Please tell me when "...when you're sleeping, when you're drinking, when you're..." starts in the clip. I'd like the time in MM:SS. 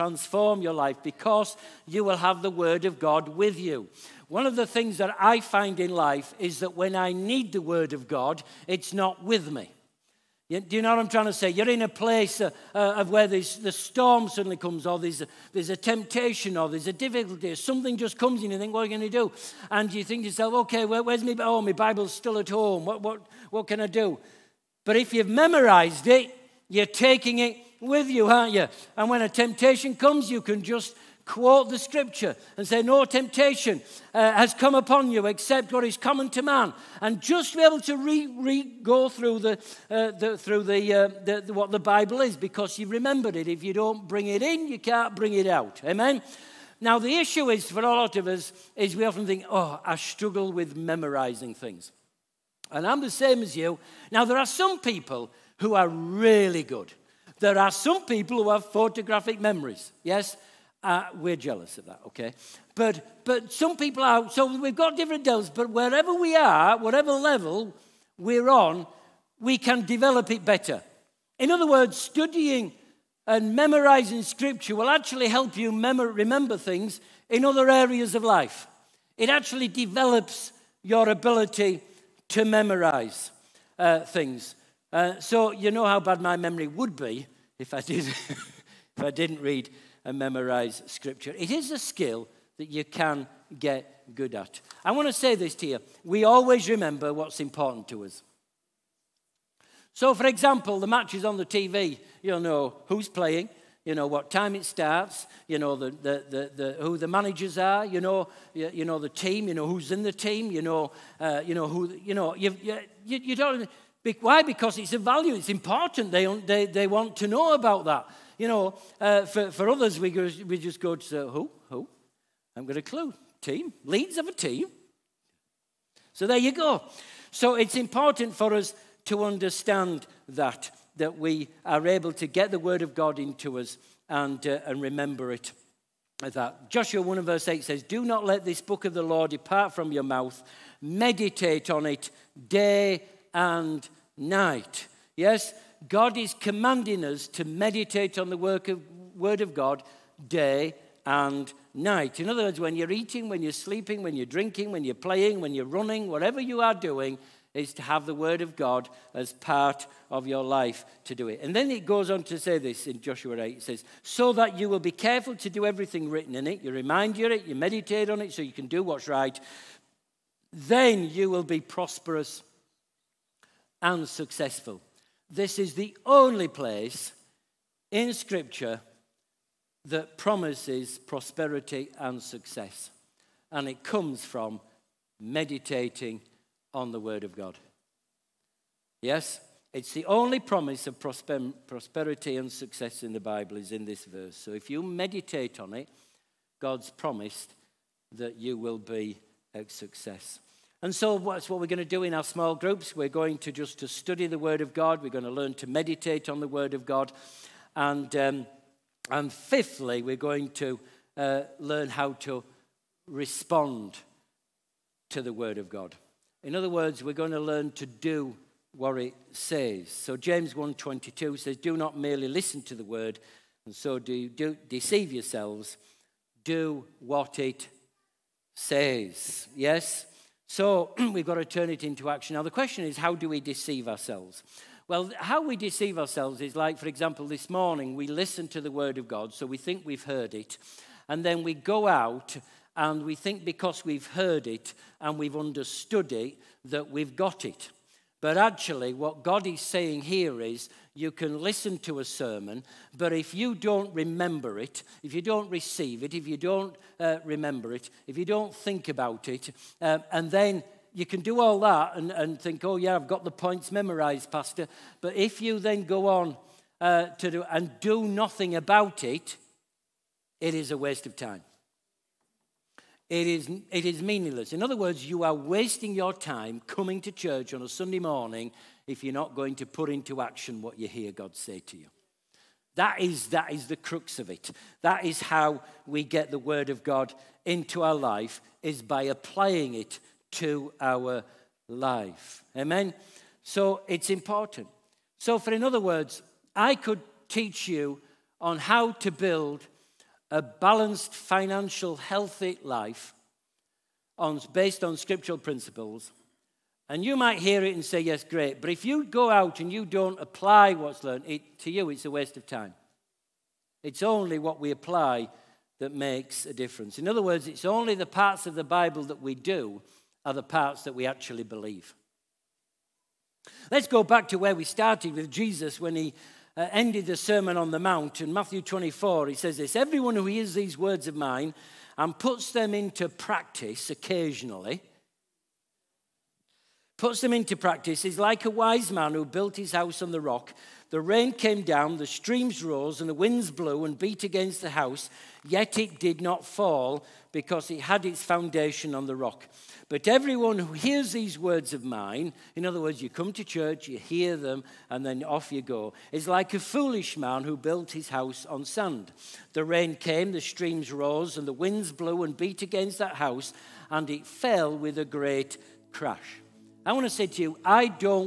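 02:33.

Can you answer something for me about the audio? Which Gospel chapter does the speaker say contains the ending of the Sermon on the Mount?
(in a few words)
Matthew 24.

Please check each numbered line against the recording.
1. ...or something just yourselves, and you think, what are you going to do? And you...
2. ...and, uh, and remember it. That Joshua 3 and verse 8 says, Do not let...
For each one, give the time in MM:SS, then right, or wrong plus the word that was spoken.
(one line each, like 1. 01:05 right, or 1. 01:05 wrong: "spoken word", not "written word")
1. 00:17 wrong: "comes", not "yourselves"
2. 02:14 wrong: "1", not "3".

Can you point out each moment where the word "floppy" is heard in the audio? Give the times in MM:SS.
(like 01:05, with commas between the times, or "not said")
not said.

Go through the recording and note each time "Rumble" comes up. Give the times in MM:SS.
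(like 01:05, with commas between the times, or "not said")
not said.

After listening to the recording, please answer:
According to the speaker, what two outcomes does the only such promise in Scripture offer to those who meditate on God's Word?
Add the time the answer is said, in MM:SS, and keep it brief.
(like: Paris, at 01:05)
prosperous and successful, at 02:51.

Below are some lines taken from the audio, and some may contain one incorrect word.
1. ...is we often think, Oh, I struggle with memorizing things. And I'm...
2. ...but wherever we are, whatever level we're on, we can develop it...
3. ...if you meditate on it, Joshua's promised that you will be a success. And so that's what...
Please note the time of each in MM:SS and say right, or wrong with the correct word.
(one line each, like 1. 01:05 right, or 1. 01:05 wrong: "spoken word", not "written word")
1. 00:48 right
2. 01:05 right
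3. 03:14 wrong: "God", not "Joshua".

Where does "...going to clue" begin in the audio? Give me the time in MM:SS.
02:02.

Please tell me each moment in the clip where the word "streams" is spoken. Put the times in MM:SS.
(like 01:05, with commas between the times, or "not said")
05:42, 06:00.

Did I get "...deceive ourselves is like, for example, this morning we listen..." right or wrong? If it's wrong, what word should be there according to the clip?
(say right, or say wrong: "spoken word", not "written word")
right.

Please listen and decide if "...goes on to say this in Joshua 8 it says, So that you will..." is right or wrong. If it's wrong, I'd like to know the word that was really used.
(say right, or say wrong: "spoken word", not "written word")
right.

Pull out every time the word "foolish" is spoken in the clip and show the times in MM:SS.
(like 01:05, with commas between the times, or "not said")
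05:56.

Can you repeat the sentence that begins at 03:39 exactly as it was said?
So James 1.22 says, Do not merely listen to the Word, and so do, do deceive yourselves.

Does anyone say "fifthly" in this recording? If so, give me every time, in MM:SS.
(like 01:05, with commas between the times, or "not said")
03:29.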